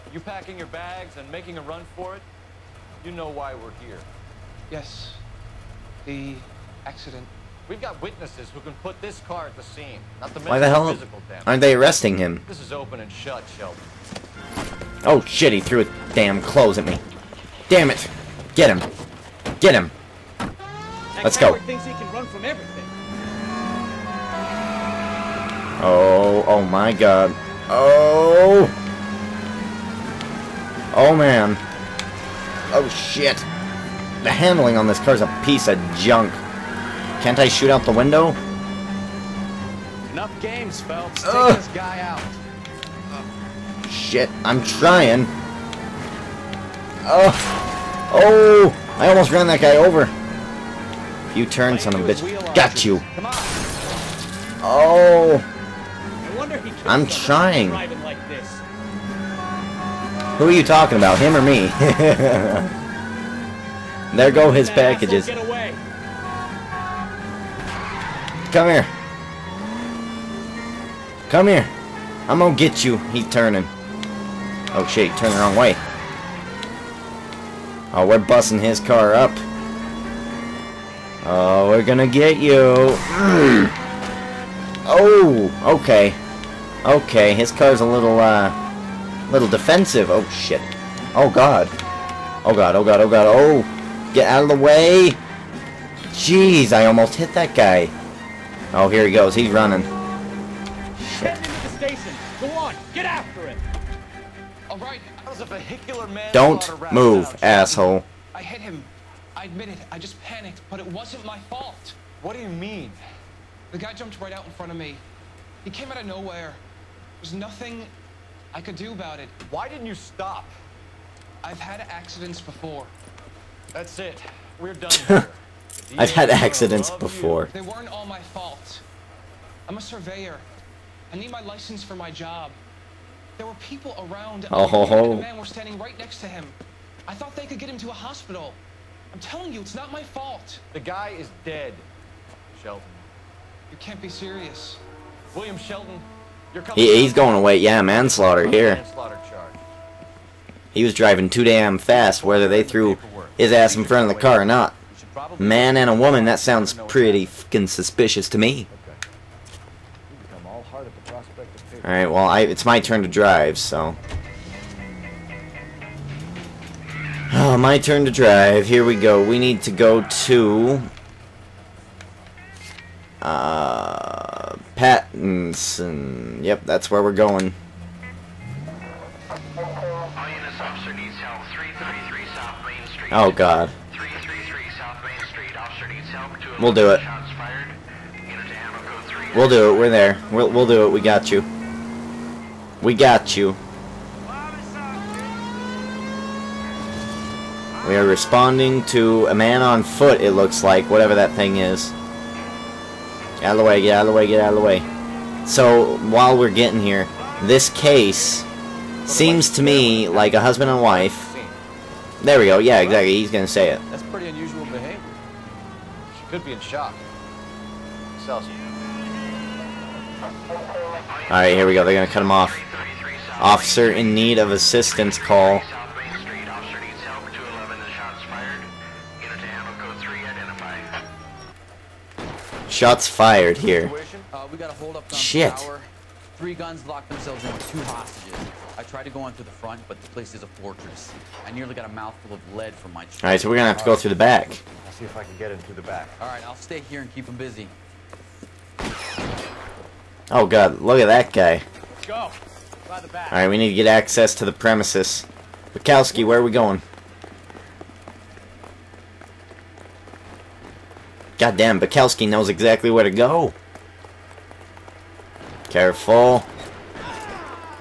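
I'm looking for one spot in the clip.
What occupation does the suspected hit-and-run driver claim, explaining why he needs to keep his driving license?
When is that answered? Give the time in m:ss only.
2:09.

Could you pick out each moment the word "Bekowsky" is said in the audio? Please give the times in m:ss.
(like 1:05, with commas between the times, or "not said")
4:15, 4:21.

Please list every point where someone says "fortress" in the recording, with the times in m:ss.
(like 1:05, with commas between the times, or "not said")
4:00.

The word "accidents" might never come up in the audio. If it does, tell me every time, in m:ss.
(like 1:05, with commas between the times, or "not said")
0:06, 2:01, 2:06.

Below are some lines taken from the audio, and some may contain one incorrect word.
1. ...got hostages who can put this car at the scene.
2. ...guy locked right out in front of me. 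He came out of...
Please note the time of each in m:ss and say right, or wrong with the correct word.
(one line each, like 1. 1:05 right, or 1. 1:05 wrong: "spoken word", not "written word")
1. 0:07 wrong: "witnesses", not "hostages"
2. 1:53 wrong: "jumped", not "locked".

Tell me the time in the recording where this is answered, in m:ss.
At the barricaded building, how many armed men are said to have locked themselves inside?
3:56.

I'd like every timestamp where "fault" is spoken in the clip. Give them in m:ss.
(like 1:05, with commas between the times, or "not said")
1:51, 2:08, 2:20.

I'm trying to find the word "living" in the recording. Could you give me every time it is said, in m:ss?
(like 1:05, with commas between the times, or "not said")
not said.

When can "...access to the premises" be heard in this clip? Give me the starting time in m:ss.
4:13.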